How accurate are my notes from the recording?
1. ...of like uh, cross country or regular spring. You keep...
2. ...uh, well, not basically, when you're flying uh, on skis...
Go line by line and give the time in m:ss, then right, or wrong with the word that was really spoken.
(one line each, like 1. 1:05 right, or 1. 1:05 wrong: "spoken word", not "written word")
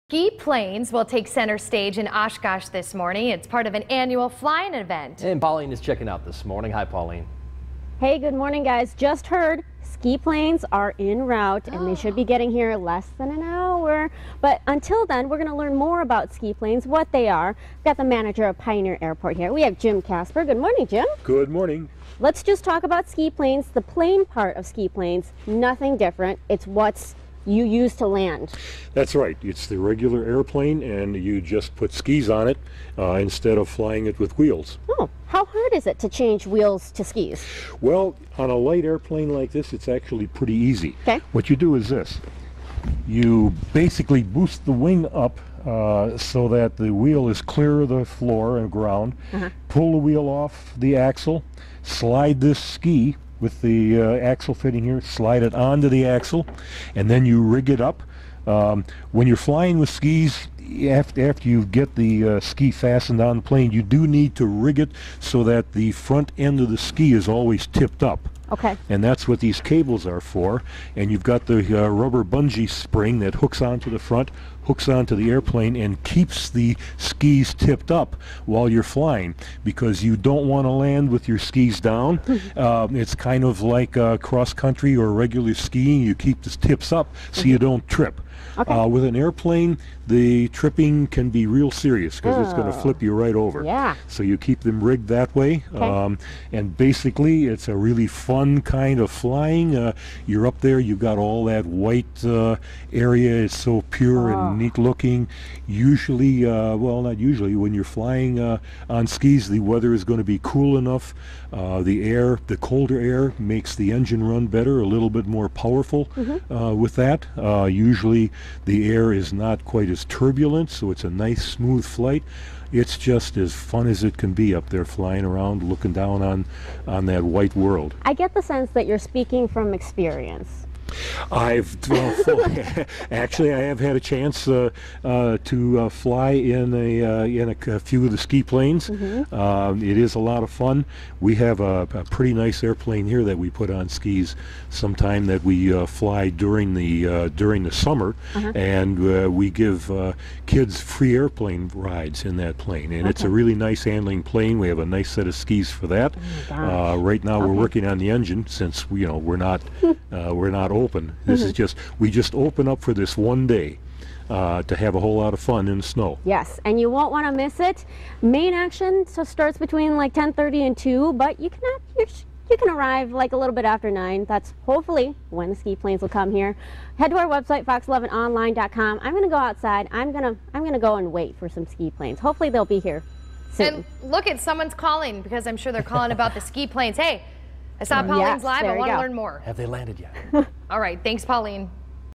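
1. 1:23 wrong: "skiing", not "spring"
2. 1:46 wrong: "usually", not "basically".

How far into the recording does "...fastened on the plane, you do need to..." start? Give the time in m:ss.
1:02.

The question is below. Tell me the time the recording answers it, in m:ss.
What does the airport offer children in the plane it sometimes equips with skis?
2:30.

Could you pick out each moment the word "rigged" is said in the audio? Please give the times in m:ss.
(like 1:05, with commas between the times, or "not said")
1:34.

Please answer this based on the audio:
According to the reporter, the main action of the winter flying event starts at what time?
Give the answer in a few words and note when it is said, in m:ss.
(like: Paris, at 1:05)
10:30, at 2:50.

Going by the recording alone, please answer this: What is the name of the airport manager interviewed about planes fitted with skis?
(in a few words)
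Jim Casper.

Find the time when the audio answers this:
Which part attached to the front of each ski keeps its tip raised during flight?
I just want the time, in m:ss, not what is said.
1:11.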